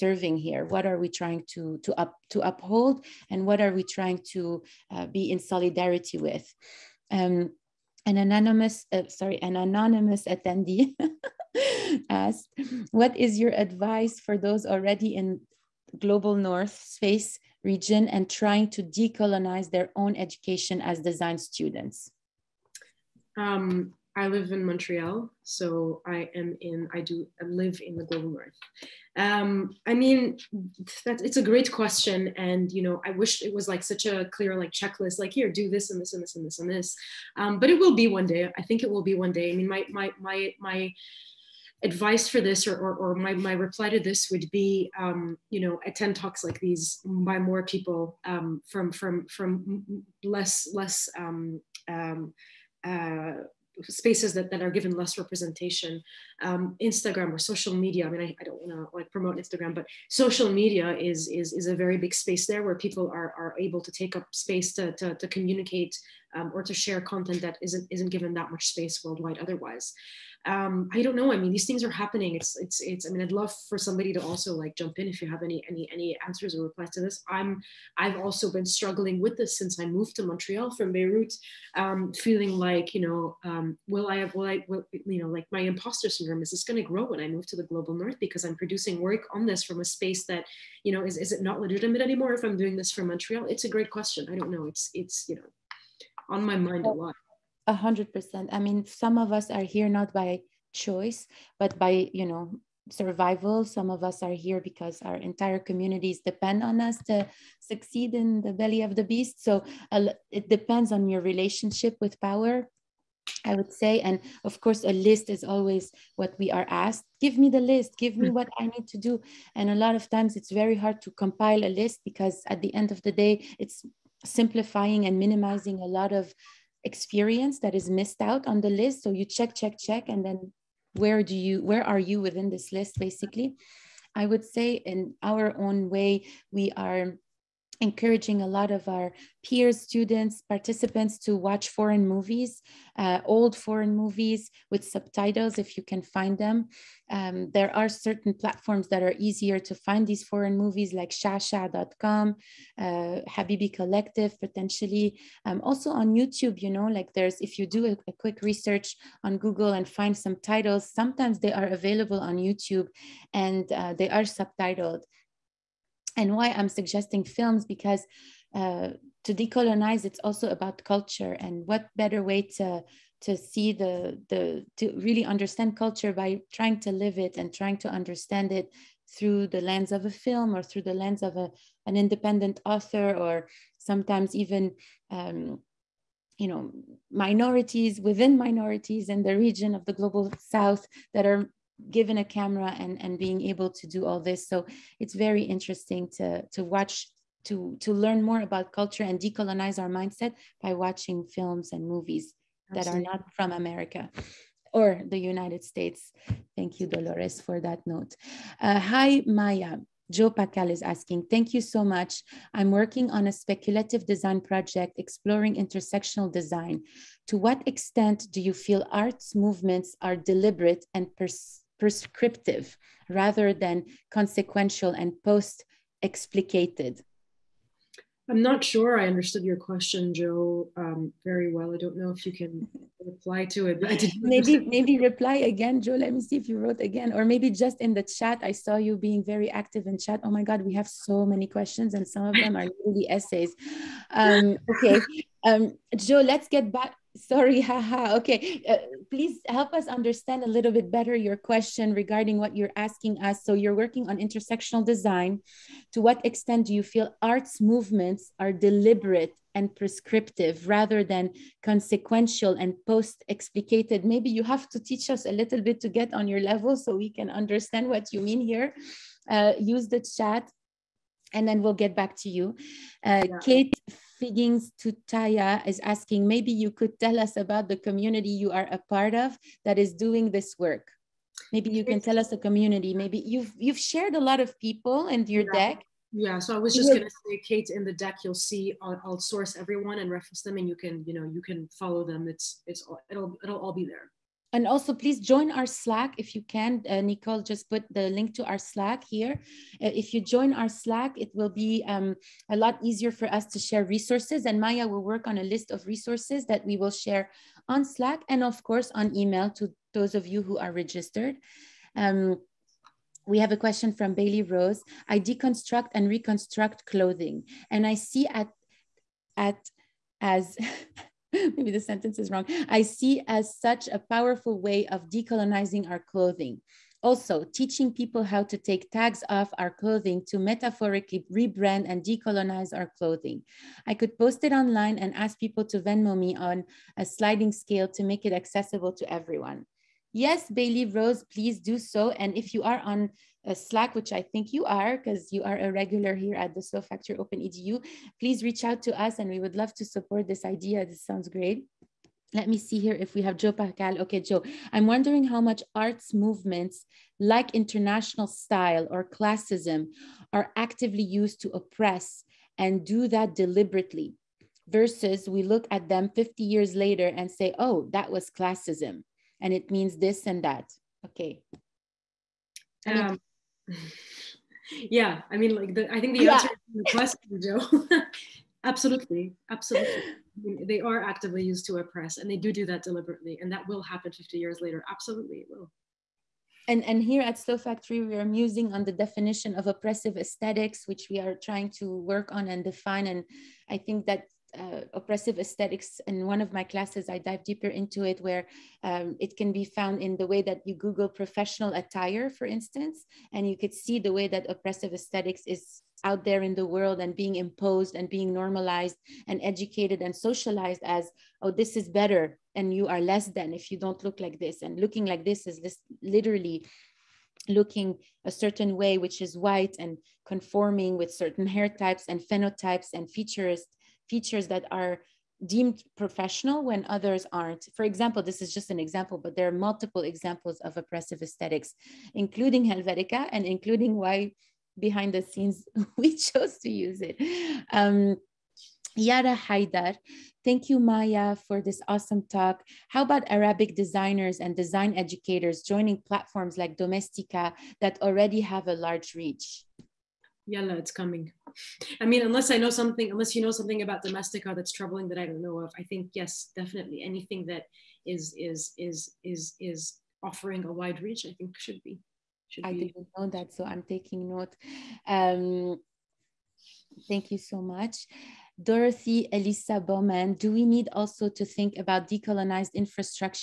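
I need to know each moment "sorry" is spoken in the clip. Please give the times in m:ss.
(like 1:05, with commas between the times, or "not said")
0:09, 4:07.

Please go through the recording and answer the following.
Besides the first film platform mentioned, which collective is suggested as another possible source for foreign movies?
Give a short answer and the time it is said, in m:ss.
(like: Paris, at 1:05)
Habibi Collective, at 2:33.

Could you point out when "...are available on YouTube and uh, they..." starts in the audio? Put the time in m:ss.
2:41.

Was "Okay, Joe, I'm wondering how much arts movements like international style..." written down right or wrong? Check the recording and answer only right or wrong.
right.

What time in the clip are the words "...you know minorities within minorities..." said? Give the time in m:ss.
3:06.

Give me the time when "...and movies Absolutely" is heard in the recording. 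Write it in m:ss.
3:21.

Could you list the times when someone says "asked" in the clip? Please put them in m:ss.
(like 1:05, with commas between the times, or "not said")
0:12, 1:56.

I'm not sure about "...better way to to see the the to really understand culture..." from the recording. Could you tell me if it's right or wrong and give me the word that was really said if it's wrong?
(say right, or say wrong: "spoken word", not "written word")
right.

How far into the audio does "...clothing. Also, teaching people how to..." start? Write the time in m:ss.
5:25.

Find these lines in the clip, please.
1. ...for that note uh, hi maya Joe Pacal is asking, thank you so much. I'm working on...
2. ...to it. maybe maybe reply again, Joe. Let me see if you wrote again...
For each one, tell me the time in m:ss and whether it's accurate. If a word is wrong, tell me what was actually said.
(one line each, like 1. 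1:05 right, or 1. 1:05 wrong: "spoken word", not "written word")
1. 3:27 right
2. 3:53 right.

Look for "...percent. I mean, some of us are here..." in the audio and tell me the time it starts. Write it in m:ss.
1:38.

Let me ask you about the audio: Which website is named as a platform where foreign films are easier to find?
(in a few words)
shasha.com.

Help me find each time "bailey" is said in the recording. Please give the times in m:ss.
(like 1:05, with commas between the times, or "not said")
5:14, 5:40.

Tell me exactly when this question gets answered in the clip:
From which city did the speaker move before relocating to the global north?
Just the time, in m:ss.
1:20.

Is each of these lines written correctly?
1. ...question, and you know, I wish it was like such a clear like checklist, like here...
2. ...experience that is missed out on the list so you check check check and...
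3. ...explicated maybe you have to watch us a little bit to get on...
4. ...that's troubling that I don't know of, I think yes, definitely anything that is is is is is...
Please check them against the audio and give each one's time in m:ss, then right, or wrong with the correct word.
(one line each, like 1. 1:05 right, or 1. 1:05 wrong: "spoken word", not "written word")
1. 0:31 right
2. 2:06 right
3. 4:23 wrong: "teach", not "watch"
4. 7:34 right.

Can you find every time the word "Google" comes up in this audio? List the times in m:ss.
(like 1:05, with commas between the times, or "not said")
2:39, 6:40.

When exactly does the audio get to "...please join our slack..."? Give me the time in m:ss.
4:54.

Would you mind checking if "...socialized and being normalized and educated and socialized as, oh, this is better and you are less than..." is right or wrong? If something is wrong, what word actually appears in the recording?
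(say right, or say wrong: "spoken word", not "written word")
wrong: "imposed", not "socialized".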